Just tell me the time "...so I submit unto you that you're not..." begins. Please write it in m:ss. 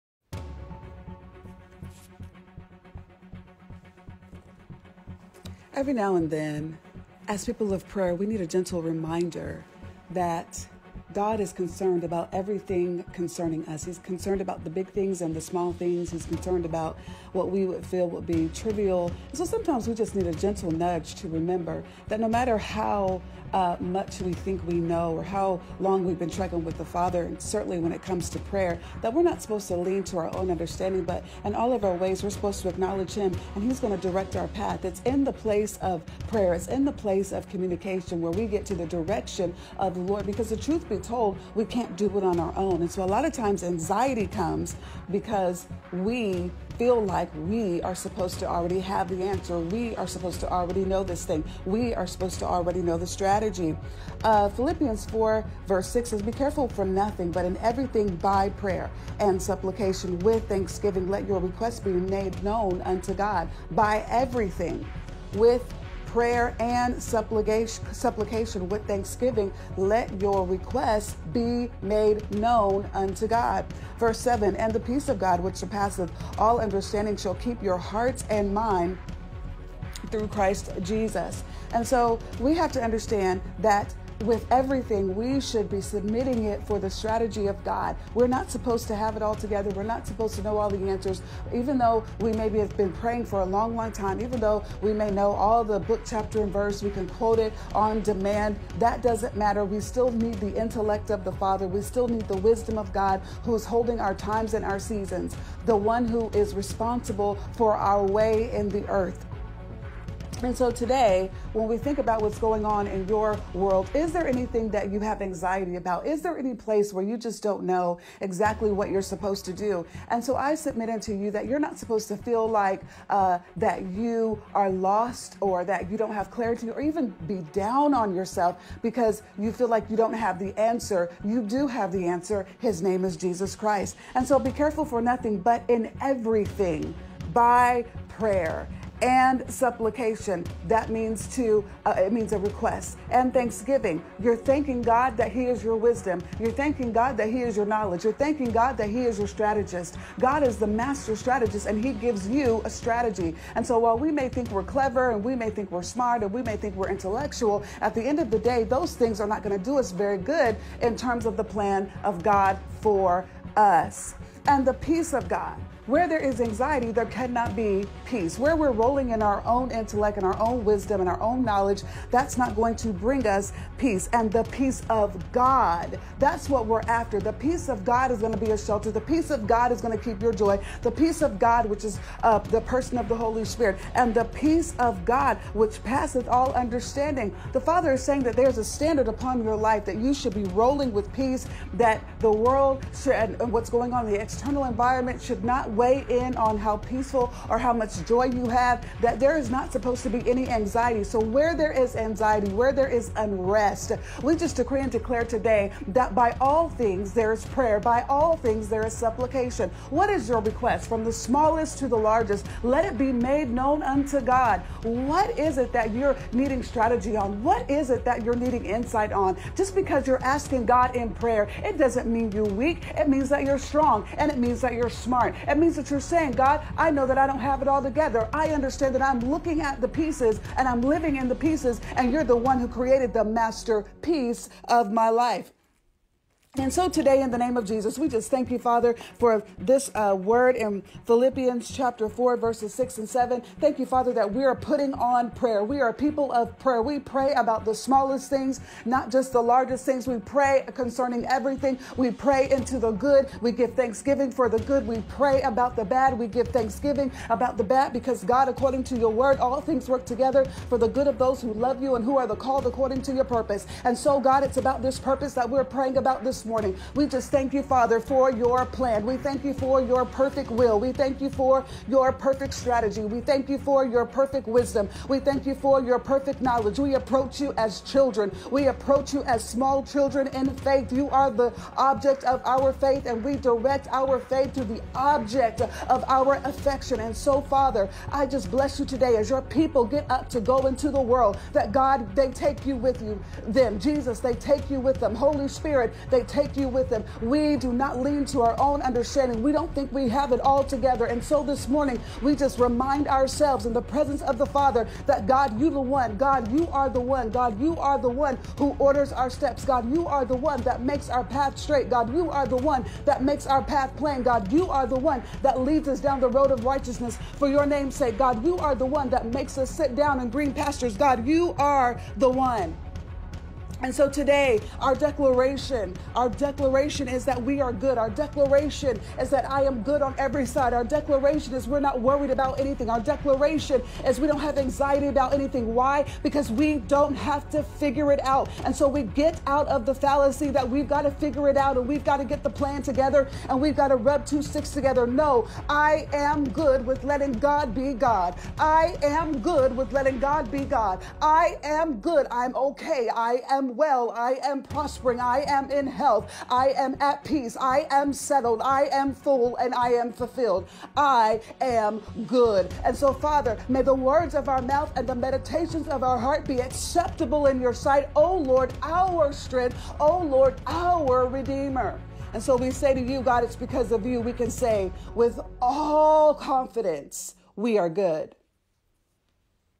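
2:00.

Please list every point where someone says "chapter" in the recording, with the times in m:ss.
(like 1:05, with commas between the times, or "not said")
1:36, 4:01.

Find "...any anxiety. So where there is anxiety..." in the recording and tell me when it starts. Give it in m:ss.
3:20.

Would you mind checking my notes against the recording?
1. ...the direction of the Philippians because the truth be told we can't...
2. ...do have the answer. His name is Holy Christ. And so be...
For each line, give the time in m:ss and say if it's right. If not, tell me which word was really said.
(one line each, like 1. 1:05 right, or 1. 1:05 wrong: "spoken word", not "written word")
1. 0:38 wrong: "Lord", not "Philippians"
2. 2:11 wrong: "Jesus", not "Holy".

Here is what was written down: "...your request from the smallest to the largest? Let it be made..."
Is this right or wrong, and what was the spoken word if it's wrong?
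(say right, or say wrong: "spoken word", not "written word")
right.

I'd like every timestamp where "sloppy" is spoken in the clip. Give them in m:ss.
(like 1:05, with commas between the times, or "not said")
not said.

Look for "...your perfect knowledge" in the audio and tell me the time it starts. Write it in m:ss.
4:35.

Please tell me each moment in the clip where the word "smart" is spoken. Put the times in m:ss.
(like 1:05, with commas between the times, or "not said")
2:35, 3:45.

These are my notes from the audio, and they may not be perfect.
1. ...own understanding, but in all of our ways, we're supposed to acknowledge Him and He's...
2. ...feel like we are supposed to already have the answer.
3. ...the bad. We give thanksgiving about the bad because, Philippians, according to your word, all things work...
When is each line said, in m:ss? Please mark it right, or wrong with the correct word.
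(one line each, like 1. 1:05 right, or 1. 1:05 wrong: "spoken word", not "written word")
1. 0:30 right
2. 0:46 right
3. 4:15 wrong: "God", not "Philippians".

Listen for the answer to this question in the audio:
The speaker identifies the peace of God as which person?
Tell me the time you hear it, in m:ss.
3:02.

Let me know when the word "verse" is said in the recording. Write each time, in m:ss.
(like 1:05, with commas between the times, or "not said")
0:55, 1:13, 1:36, 4:02.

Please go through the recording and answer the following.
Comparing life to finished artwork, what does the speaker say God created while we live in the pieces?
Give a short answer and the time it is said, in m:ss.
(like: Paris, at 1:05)
the masterpiece, at 3:53.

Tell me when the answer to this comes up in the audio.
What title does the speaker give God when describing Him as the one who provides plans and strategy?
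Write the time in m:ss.
2:30.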